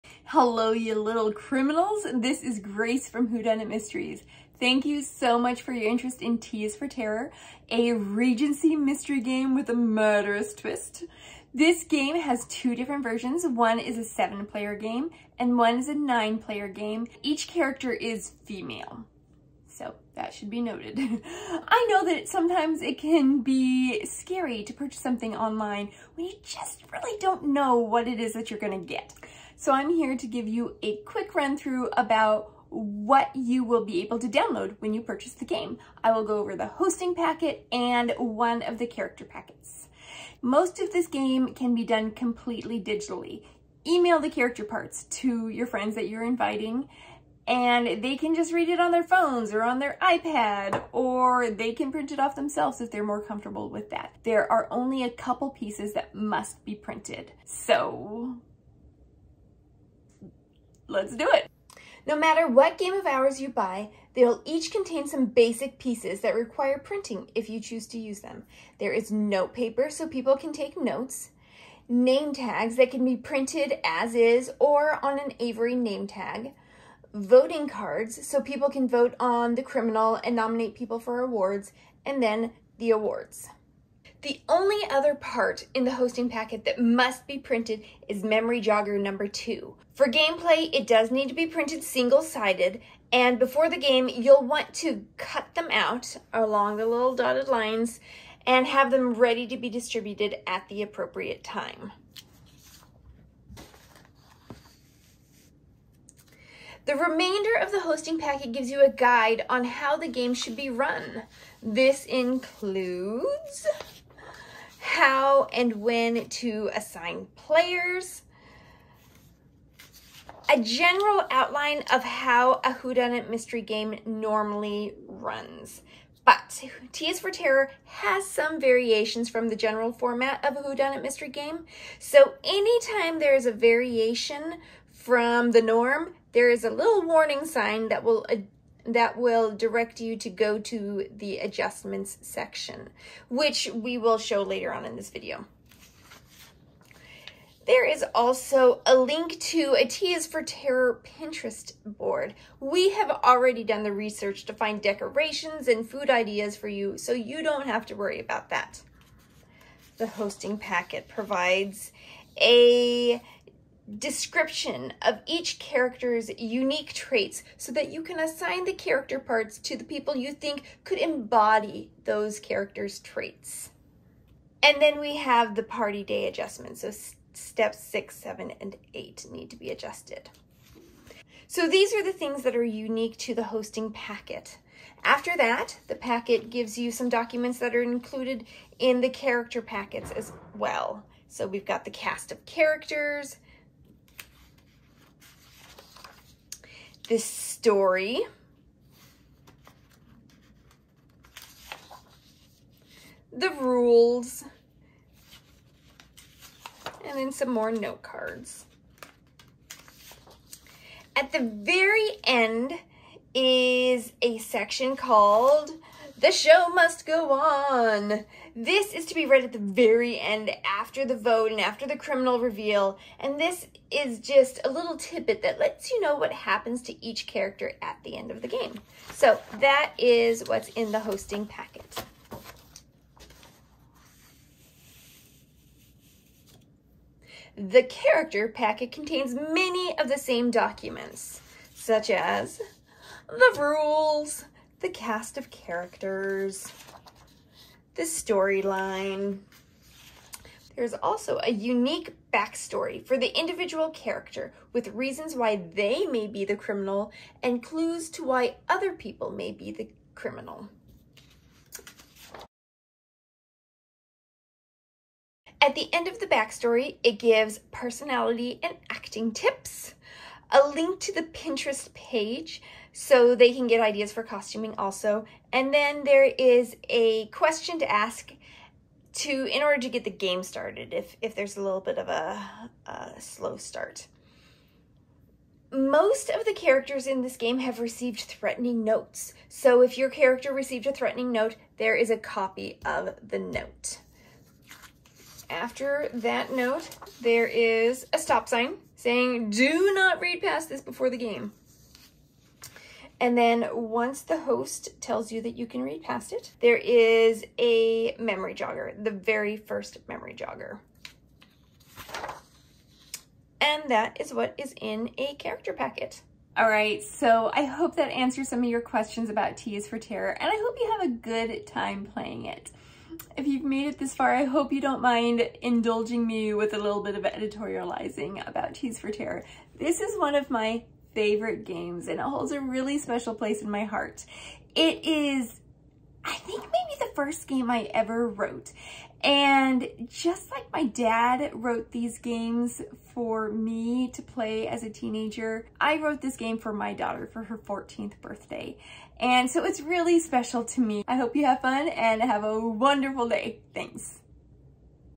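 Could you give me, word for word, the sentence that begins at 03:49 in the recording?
So that is what's in the hosting packet.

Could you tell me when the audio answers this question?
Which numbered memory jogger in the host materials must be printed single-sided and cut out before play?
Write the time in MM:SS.
01:28.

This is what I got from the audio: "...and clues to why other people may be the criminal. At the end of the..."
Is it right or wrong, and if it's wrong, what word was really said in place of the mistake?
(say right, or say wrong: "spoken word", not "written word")
right.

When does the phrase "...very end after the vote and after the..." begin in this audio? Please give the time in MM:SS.
03:39.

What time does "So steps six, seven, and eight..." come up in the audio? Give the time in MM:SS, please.
02:56.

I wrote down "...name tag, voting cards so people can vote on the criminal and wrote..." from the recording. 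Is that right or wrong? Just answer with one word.
wrong.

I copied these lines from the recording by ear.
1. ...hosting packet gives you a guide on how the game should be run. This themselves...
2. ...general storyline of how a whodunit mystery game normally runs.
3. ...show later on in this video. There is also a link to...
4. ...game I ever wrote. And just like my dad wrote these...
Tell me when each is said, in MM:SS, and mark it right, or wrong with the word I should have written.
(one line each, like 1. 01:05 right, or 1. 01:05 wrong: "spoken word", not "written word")
1. 01:47 wrong: "includes", not "themselves"
2. 02:00 wrong: "outline", not "storyline"
3. 02:24 right
4. 05:37 right.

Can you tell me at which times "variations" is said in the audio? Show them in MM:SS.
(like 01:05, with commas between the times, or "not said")
02:08, 02:13.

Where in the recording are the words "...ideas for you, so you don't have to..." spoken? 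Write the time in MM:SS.
02:36.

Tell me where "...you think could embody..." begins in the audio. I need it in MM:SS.
02:50.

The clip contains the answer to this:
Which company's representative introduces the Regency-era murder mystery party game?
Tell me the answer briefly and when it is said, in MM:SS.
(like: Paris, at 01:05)
Whodunnit Mysteries, at 00:03.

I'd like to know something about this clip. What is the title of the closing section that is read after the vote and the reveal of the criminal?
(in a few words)
The Show Must Go On.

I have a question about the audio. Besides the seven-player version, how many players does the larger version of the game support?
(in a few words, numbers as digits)
9.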